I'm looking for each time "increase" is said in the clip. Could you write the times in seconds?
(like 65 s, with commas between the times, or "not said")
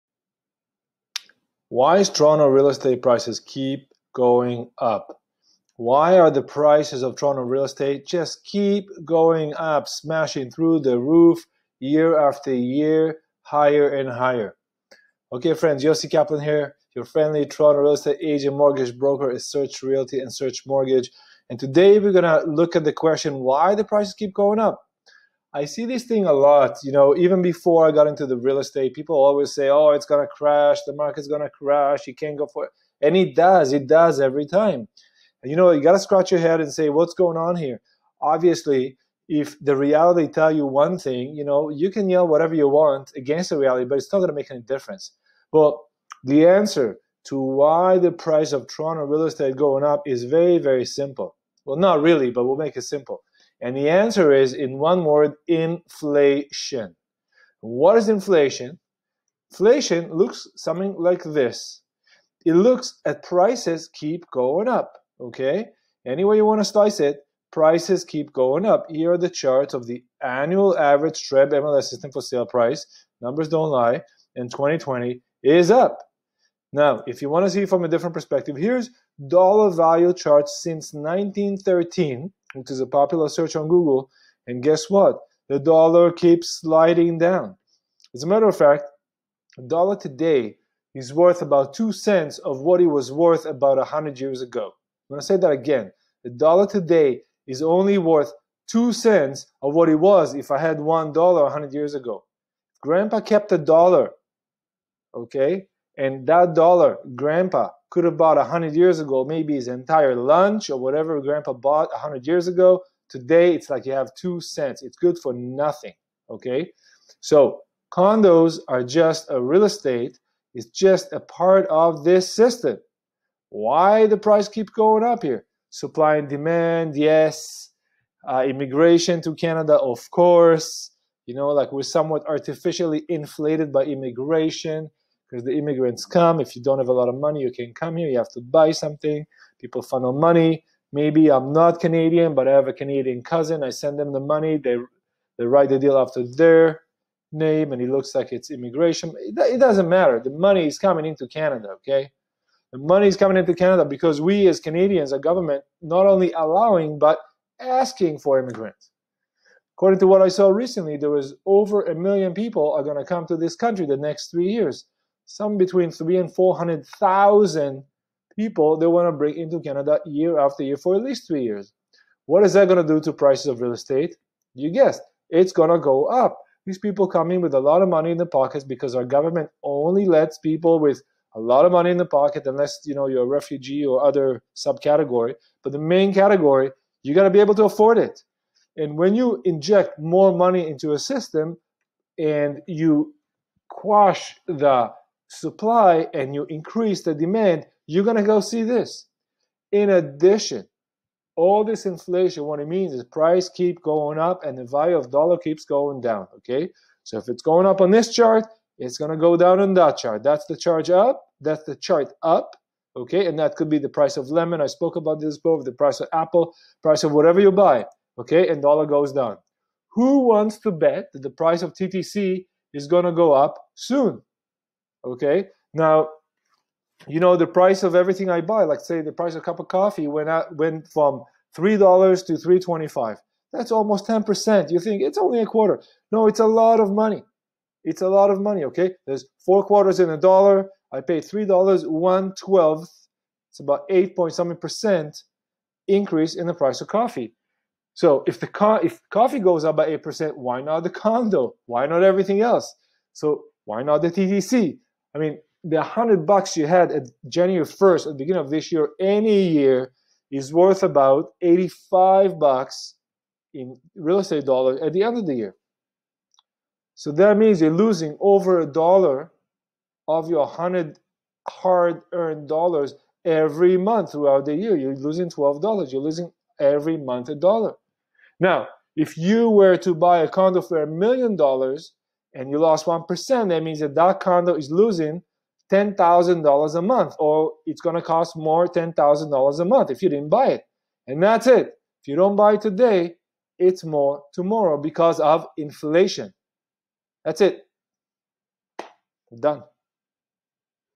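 196 s, 245 s.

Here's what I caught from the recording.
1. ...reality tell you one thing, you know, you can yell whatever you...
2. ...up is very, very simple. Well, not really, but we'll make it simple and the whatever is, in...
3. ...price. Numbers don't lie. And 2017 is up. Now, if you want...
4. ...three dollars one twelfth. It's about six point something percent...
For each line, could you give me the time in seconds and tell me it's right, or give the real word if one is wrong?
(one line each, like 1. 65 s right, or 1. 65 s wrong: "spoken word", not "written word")
1. 39 s right
2. 49 s wrong: "answer", not "whatever"
3. 72 s wrong: "2020", not "2017"
4. 241 s wrong: "eight", not "six".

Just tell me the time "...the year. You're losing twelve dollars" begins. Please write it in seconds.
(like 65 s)
274 s.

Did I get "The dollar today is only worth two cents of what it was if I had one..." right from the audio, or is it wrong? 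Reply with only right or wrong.
right.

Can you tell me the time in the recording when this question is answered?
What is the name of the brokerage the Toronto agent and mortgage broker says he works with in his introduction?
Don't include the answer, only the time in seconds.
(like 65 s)
19 s.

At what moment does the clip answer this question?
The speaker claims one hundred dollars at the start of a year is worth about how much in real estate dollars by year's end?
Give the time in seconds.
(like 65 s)
261 s.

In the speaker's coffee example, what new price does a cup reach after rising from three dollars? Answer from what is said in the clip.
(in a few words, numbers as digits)
$3.25.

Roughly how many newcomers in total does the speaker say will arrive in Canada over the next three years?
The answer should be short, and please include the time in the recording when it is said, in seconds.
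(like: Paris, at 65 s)
over 1 million, at 161 s.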